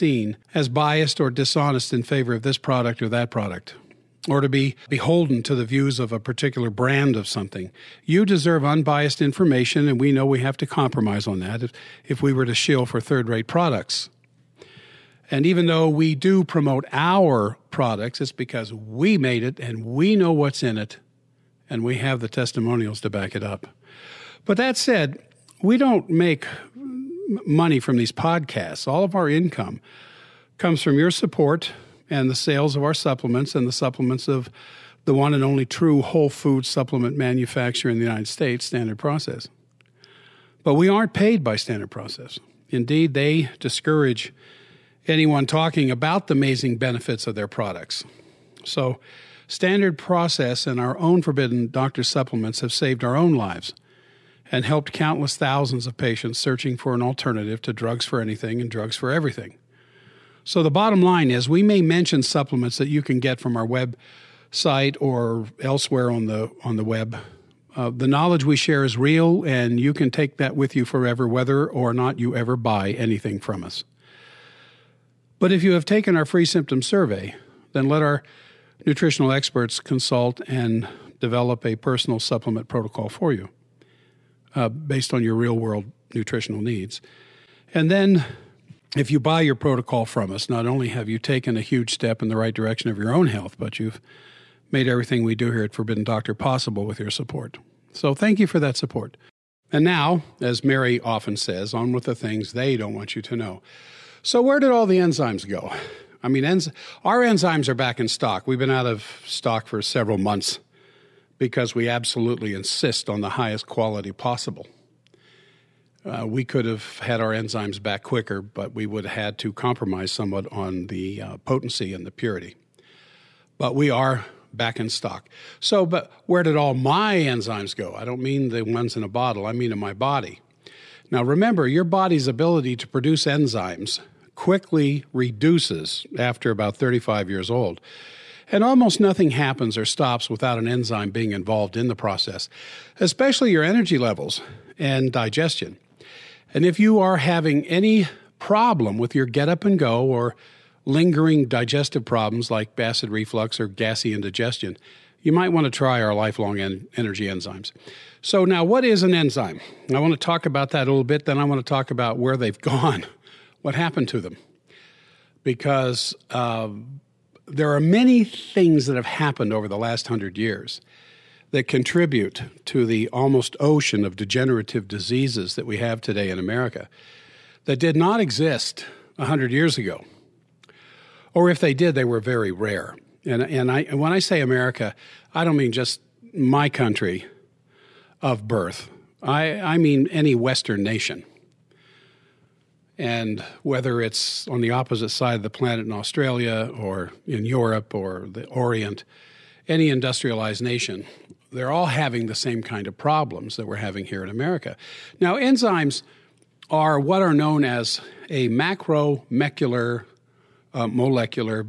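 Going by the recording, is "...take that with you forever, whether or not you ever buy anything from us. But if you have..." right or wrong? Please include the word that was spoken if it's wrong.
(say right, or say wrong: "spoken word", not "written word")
right.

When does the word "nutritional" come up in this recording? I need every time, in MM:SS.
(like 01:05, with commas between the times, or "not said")
01:18, 01:26.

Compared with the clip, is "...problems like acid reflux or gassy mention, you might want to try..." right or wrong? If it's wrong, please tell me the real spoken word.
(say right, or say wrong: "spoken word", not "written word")
wrong: "indigestion", not "mention".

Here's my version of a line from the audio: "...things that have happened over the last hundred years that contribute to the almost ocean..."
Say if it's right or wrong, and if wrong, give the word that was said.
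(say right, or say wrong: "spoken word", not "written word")
right.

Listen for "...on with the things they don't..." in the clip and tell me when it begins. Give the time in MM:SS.
01:41.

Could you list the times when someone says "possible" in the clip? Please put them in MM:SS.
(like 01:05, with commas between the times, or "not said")
01:36, 01:54.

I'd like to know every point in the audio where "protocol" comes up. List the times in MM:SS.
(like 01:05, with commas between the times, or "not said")
01:22, 01:29.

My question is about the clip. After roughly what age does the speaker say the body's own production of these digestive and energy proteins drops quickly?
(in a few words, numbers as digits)
35.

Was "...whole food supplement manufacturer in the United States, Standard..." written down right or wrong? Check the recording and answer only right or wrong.
right.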